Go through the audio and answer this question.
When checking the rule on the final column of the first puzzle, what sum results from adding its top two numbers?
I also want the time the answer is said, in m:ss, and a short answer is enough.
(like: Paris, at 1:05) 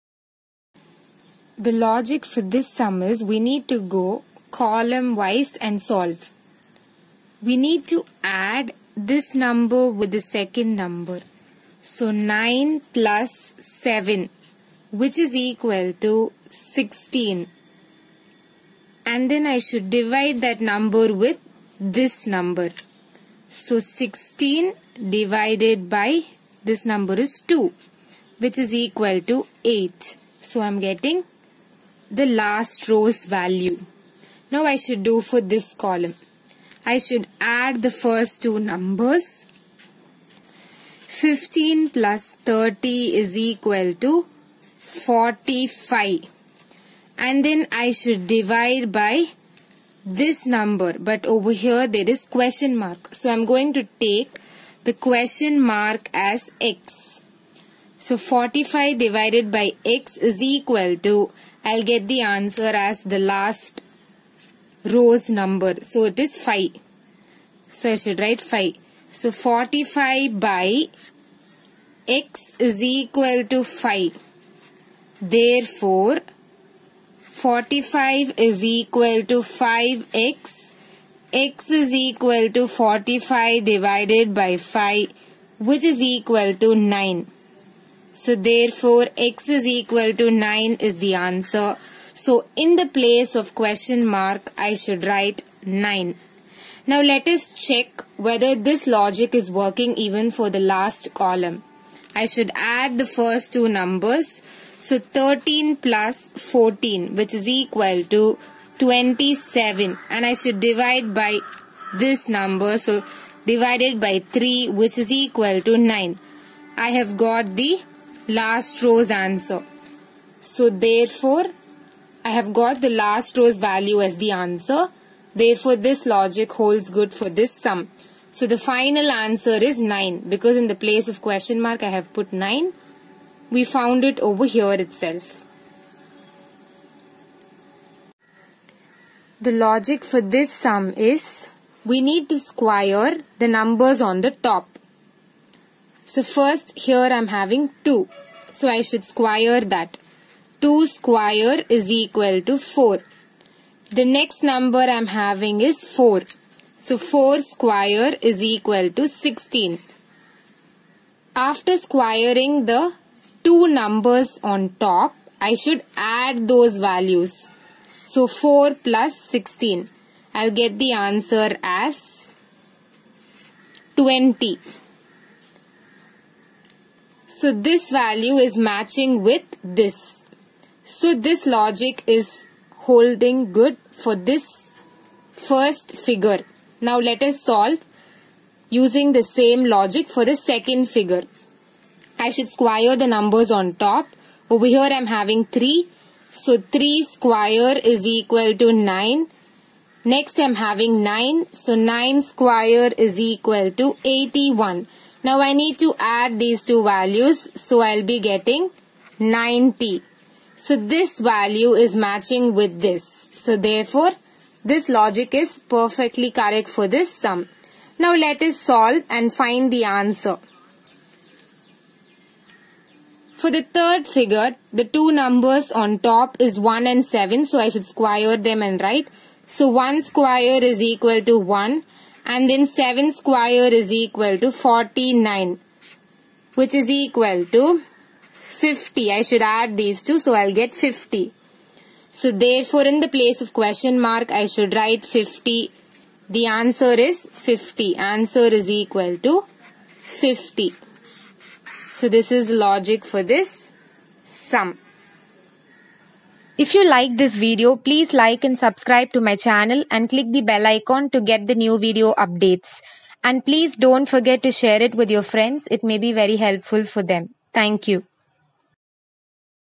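27, at 1:48.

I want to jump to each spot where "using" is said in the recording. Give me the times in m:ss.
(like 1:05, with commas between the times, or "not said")
3:08.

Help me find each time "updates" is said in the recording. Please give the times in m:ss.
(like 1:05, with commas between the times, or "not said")
4:22.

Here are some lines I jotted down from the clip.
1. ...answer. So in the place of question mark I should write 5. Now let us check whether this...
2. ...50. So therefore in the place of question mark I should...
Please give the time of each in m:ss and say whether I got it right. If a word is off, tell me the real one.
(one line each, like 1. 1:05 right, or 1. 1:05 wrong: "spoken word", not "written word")
1. 1:31 wrong: "9", not "5"
2. 4:00 right.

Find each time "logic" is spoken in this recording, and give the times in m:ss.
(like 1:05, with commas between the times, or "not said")
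0:01, 1:38, 2:06, 2:19, 3:01, 3:09, 3:34, 4:12.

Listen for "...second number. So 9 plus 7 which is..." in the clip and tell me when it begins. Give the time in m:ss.
0:10.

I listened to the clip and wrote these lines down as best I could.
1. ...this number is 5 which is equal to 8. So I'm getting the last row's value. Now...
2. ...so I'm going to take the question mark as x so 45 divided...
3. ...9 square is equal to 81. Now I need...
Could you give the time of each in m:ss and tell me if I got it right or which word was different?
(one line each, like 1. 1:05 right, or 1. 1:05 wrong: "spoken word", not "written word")
1. 0:26 wrong: "2", not "5"
2. 0:53 right
3. 3:21 right.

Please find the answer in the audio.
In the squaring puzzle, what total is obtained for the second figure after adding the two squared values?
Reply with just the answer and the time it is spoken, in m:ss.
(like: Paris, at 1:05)
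90, at 3:29.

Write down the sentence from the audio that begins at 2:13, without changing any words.
We found it over here itself.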